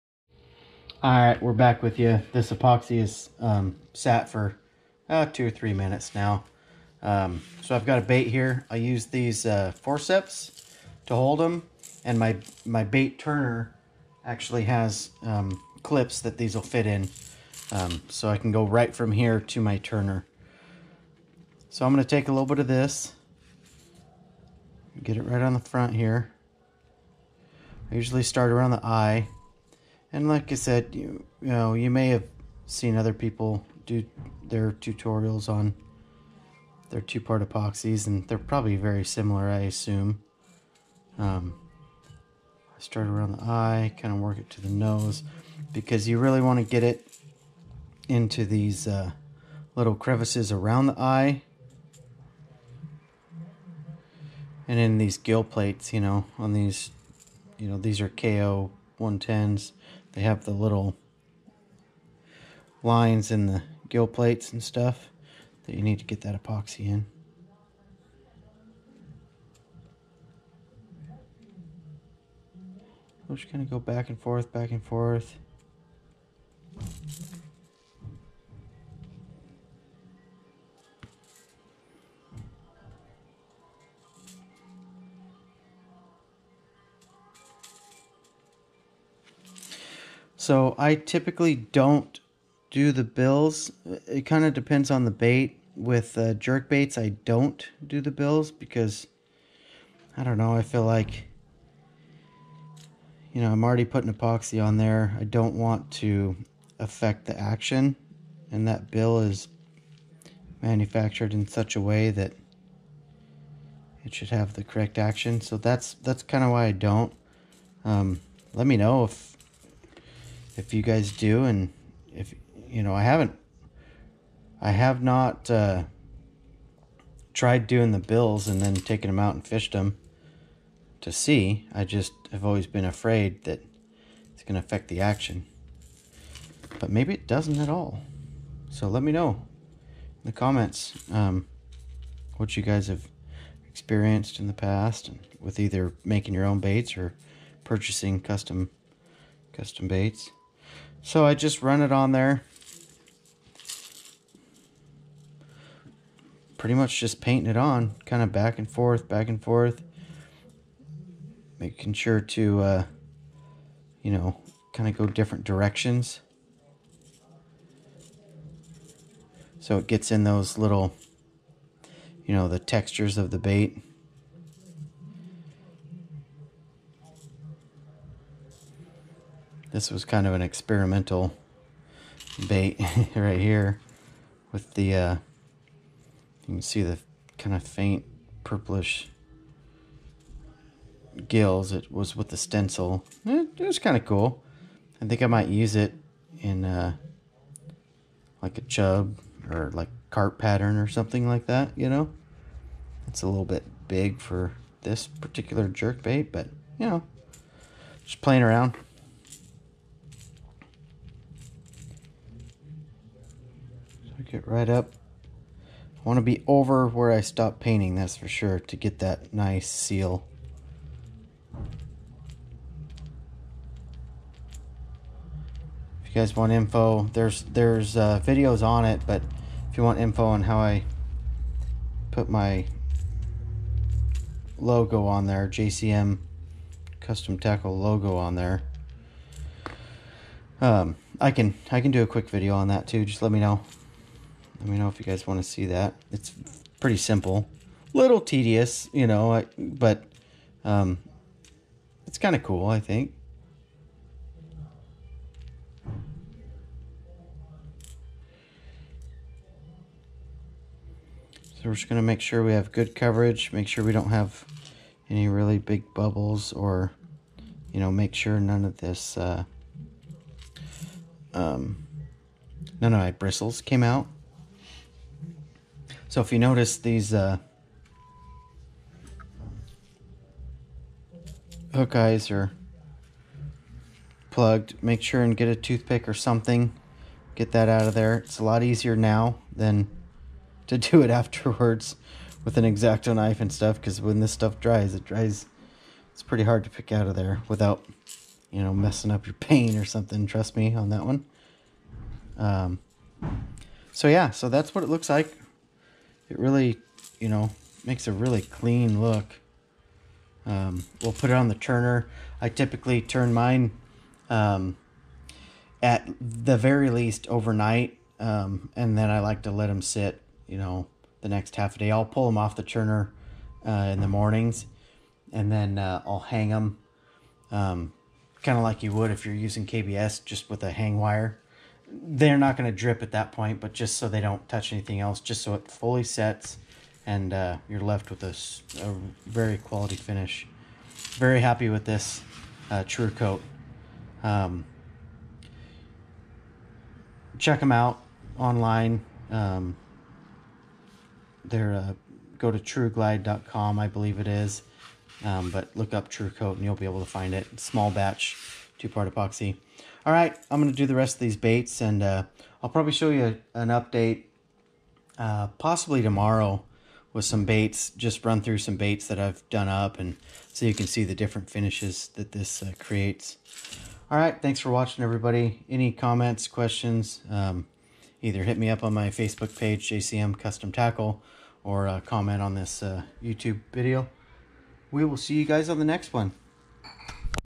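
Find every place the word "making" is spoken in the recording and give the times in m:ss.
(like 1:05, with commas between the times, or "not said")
2:26, 2:41.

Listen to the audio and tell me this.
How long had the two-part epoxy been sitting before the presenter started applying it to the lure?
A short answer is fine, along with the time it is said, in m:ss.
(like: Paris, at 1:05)
2 or 3 minutes, at 0:05.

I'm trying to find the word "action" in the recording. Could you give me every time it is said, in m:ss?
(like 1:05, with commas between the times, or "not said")
1:47, 1:54, 2:15.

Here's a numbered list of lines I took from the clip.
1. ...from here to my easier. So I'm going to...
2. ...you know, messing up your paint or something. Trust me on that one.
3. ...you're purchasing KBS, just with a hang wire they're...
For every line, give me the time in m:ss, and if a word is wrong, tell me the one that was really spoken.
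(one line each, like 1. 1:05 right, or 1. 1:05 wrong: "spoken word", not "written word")
1. 0:18 wrong: "turner", not "easier"
2. 4:58 right
3. 5:29 wrong: "using", not "purchasing".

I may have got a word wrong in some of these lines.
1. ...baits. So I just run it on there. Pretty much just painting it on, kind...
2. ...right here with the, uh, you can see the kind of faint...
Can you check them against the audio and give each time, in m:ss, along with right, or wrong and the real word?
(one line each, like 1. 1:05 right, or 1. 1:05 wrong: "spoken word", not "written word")
1. 2:29 right
2. 3:03 right.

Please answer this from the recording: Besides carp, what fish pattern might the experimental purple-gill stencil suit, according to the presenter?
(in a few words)
Chub.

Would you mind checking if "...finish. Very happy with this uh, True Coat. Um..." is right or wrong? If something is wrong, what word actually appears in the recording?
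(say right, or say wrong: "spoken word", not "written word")
right.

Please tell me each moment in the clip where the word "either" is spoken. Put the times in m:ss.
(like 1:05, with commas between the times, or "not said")
2:25, 6:18.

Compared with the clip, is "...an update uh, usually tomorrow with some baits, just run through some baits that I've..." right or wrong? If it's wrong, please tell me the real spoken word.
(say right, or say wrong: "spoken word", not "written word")
wrong: "possibly", not "usually".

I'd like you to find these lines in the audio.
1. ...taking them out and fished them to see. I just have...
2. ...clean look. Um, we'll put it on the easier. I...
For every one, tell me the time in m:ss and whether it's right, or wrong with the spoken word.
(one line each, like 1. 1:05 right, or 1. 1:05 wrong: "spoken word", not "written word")
1. 2:08 right
2. 5:08 wrong: "turner", not "easier".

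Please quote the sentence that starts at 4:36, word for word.
So if you notice these uh, hook eyes are plugged, make sure and get a toothpick or something.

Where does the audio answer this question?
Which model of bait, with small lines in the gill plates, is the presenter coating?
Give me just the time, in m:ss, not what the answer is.
0:58.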